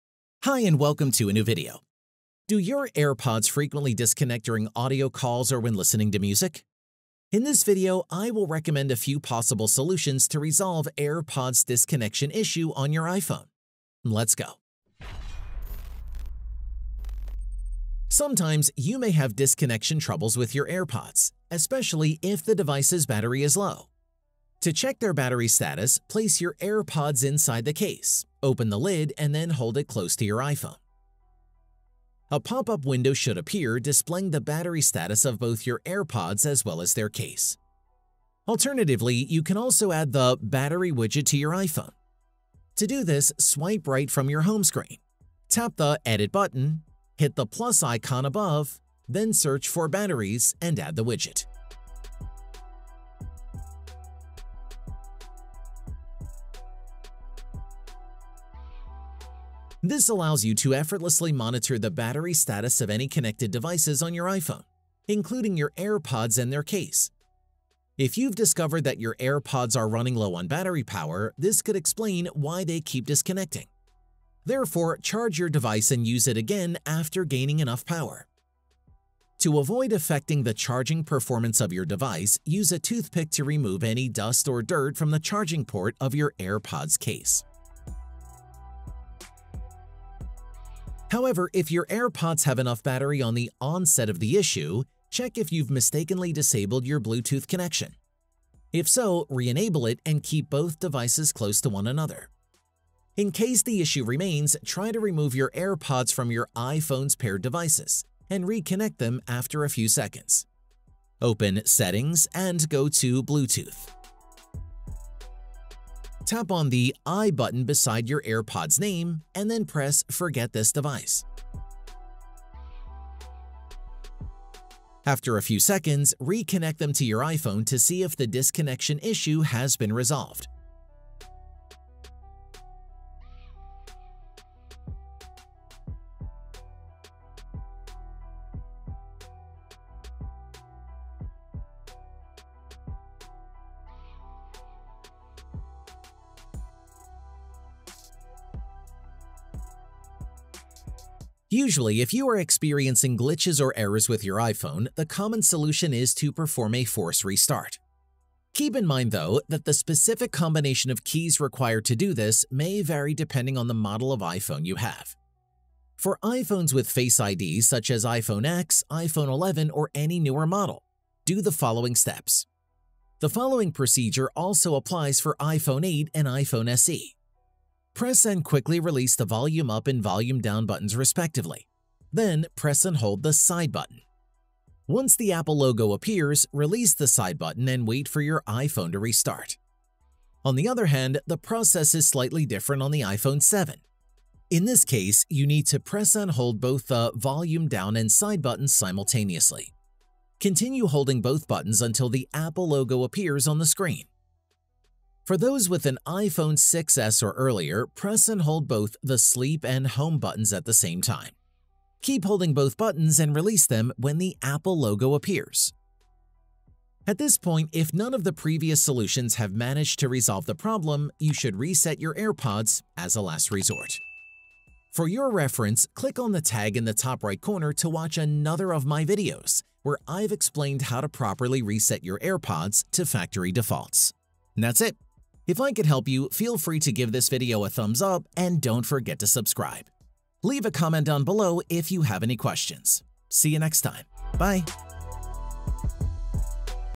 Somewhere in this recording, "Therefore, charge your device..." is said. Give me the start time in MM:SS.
01:14.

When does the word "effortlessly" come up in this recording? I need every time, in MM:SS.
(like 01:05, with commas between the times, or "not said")
01:00.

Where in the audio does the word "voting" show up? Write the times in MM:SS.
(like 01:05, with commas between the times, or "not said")
not said.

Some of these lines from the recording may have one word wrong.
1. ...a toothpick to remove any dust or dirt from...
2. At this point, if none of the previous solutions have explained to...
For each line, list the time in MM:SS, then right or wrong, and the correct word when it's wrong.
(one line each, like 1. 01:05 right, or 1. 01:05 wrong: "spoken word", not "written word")
1. 01:22 right
2. 03:37 wrong: "managed", not "explained".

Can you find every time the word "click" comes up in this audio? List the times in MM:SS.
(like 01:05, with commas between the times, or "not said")
03:45.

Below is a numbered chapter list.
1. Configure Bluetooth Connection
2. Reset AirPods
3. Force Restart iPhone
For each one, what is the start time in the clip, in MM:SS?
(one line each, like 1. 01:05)
1. 01:30
2. 03:36
3. 02:31.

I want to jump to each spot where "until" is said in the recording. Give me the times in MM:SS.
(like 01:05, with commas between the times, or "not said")
03:21.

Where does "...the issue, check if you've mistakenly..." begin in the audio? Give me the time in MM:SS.
01:34.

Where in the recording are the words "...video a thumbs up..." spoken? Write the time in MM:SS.
03:57.